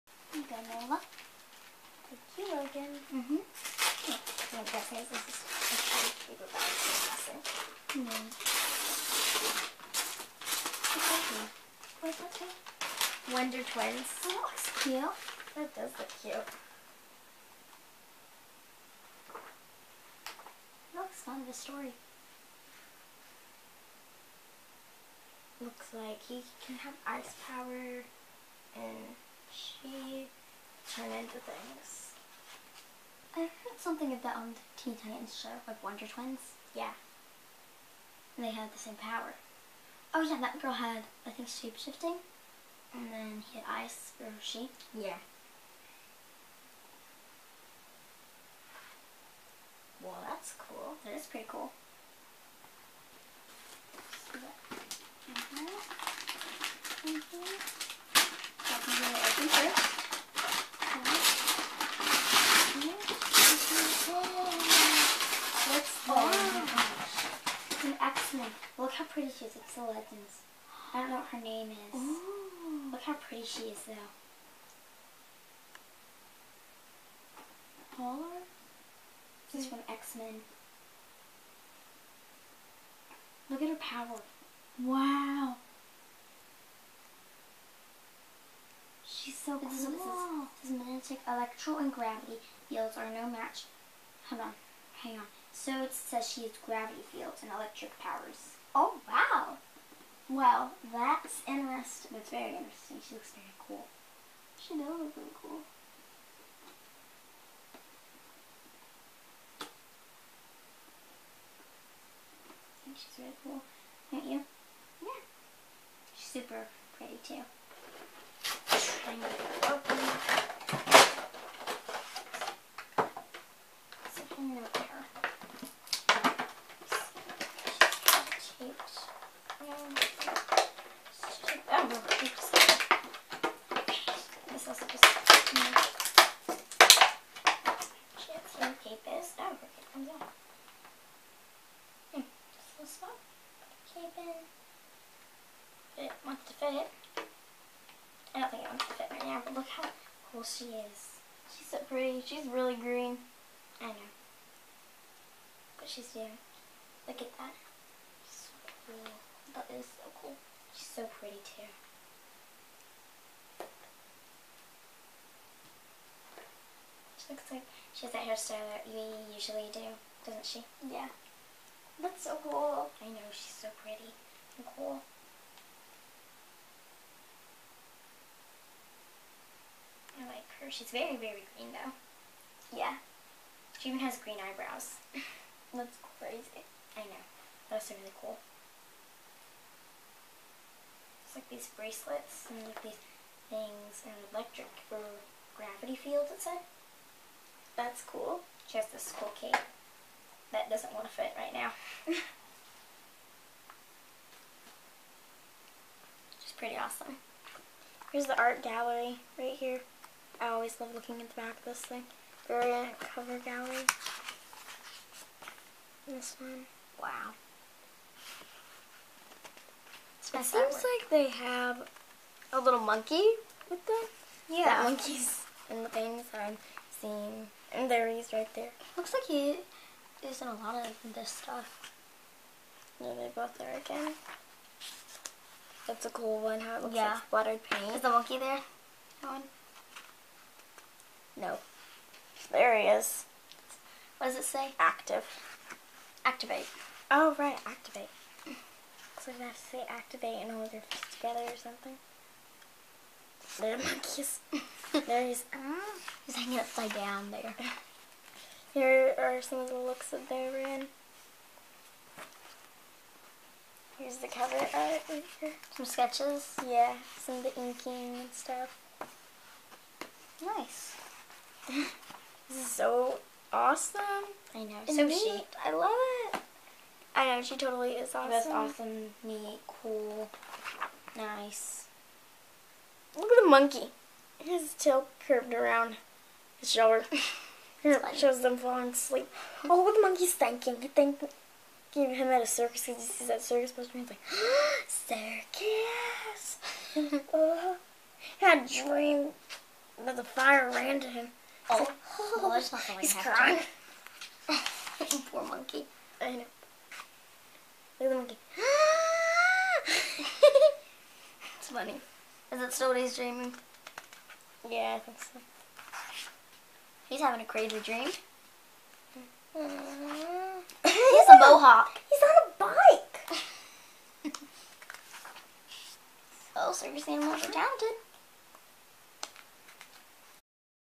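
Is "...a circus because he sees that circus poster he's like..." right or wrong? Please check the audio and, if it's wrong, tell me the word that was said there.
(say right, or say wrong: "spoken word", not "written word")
right.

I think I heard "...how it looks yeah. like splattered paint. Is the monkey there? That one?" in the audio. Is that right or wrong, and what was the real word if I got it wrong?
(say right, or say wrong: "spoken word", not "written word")
right.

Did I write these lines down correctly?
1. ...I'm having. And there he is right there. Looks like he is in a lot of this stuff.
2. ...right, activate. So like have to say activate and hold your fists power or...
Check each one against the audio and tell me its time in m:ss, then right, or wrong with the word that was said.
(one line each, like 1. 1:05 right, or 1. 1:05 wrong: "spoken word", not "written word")
1. 3:46 wrong: "seeing", not "having"
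2. 4:07 wrong: "together", not "power".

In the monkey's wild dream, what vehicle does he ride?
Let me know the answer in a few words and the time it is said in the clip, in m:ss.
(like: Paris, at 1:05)
A bike, at 5:24.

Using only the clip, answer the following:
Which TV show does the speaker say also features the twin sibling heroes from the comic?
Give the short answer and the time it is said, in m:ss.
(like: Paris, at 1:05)
Teen Titans, at 0:34.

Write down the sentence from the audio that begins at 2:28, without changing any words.
I don't think it wants to fit right now, but look how cool she is.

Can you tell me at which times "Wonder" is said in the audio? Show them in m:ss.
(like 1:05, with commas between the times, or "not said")
0:13, 0:35.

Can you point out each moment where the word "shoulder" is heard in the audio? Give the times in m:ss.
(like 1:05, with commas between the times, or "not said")
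4:46.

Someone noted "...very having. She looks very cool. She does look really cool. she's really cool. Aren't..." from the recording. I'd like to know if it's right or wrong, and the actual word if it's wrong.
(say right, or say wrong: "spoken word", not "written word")
wrong: "interesting", not "having".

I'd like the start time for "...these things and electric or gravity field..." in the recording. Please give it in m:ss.
3:12.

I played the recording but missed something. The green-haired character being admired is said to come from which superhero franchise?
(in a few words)
X-Men.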